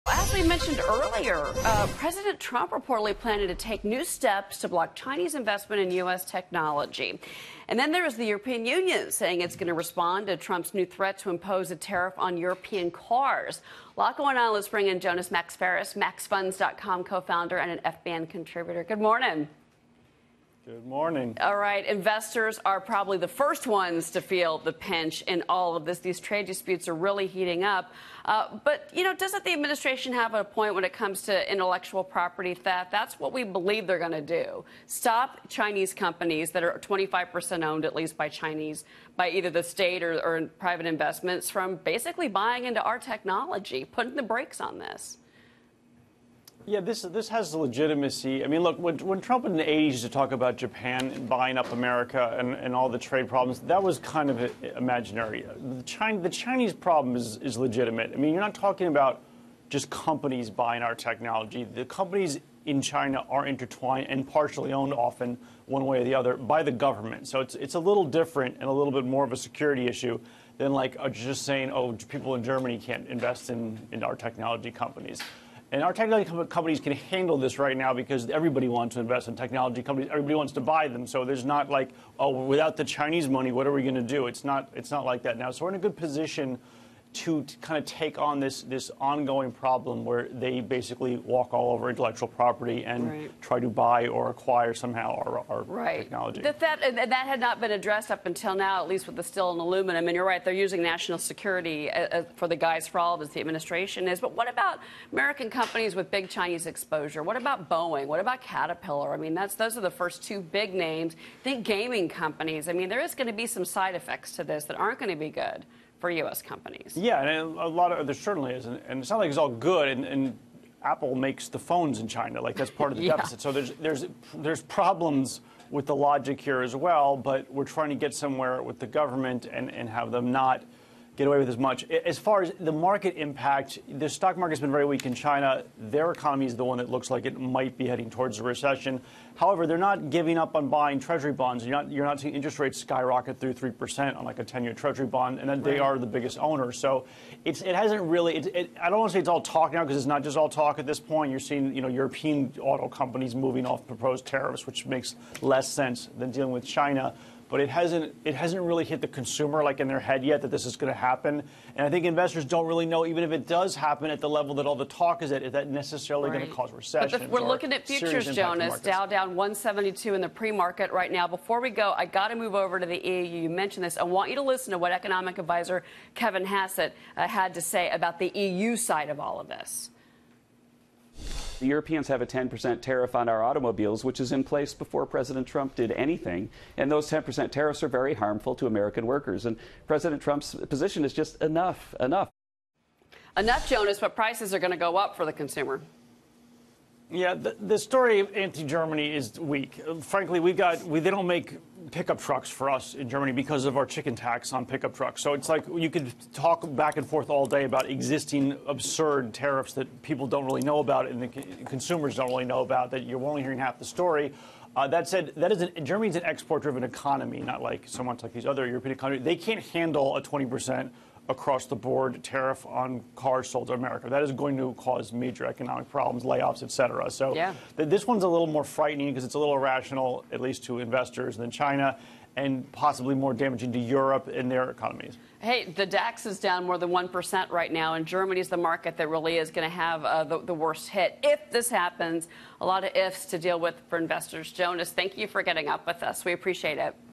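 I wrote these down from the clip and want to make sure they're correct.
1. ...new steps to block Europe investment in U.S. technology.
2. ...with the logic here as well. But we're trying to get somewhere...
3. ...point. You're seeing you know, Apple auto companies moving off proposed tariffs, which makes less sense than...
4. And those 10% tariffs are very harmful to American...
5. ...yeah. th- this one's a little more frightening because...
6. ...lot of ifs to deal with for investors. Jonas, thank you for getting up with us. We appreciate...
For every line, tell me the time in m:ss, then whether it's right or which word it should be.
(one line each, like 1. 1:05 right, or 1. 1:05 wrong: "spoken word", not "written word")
1. 0:03 wrong: "Chinese", not "Europe"
2. 2:05 right
3. 2:30 wrong: "European", not "Apple"
4. 3:06 right
5. 3:47 right
6. 4:02 right.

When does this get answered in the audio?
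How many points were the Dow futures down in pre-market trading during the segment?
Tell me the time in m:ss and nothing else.
2:49.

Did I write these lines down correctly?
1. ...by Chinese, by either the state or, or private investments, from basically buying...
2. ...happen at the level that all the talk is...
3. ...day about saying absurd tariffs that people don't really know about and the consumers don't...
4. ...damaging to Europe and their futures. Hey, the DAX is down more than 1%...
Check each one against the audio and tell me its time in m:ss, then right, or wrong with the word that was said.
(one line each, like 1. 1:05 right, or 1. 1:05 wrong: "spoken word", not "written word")
1. 0:38 right
2. 2:43 right
3. 3:27 wrong: "existing", not "saying"
4. 3:53 wrong: "economies", not "futures".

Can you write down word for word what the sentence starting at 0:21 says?
All right, investors are probably the first ones to feel the pinch in all of this.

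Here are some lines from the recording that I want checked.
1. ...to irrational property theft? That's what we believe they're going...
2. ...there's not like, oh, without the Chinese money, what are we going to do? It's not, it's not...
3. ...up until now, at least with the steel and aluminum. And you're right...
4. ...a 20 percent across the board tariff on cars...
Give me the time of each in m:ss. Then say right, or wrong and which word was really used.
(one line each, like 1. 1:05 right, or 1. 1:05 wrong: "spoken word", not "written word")
1. 0:31 wrong: "intellectual", not "irrational"
2. 1:21 right
3. 1:38 right
4. 3:40 right.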